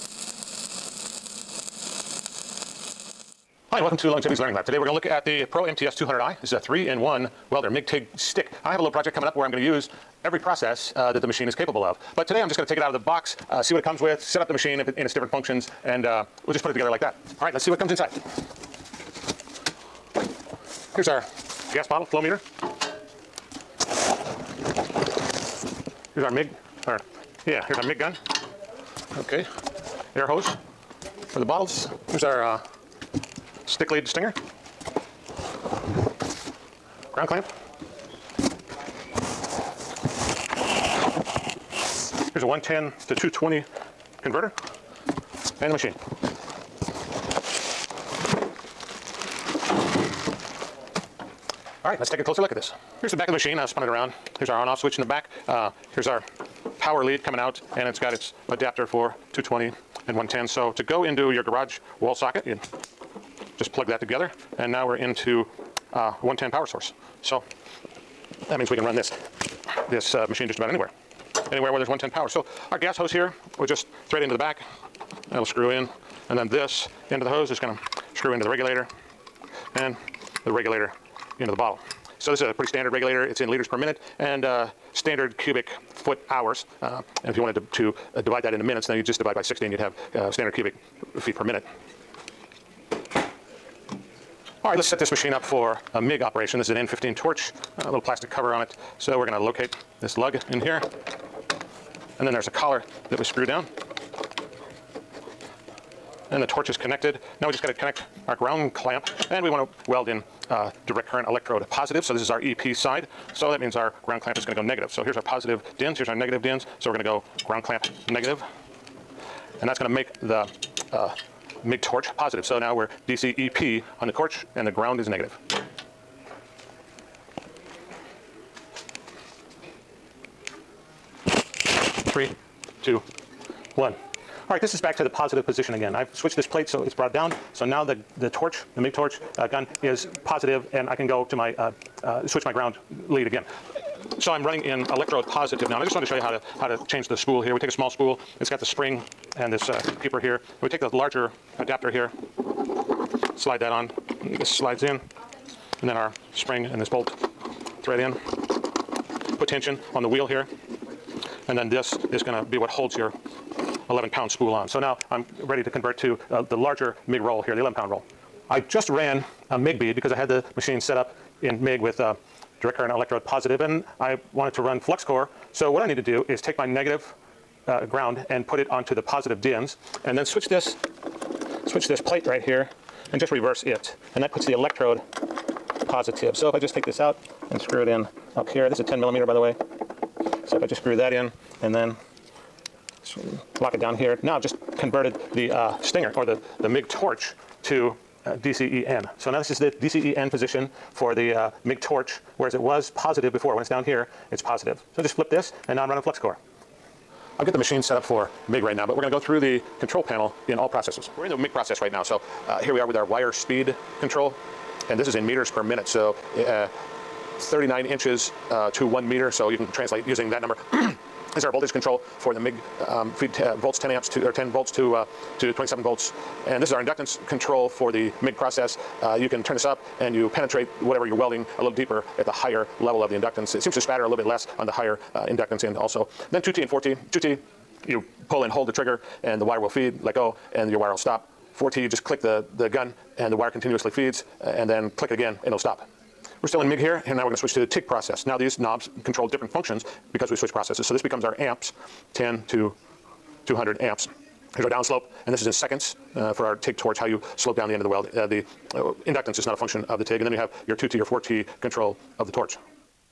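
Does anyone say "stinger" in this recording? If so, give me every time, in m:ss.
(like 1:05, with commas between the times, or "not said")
0:34, 3:15.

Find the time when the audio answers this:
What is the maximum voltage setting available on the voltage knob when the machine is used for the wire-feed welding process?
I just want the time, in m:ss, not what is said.
3:45.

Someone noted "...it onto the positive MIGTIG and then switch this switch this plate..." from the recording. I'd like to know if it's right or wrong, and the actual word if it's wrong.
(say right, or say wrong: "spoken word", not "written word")
wrong: "DINs", not "MIGTIG".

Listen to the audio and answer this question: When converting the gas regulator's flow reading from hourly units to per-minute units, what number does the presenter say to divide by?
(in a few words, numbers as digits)
16.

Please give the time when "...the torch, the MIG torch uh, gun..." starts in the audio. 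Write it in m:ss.
2:18.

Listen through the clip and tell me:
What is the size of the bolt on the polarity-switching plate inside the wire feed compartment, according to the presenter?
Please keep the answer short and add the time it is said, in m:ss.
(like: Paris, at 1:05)
10 millimeter, at 3:08.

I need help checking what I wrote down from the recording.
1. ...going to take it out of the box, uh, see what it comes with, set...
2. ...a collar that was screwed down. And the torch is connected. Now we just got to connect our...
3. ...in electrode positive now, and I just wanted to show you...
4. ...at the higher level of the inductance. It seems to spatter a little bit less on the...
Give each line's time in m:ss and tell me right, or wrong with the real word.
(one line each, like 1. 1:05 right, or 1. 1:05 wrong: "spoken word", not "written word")
1. 0:12 right
2. 1:42 right
3. 2:24 right
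4. 3:52 right.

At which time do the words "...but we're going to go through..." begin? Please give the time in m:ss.
3:28.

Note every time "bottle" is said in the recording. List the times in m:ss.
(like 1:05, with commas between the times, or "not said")
0:21, 0:31, 1:21.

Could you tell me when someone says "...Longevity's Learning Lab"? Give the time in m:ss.
0:04.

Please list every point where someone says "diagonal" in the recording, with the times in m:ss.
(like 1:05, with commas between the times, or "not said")
not said.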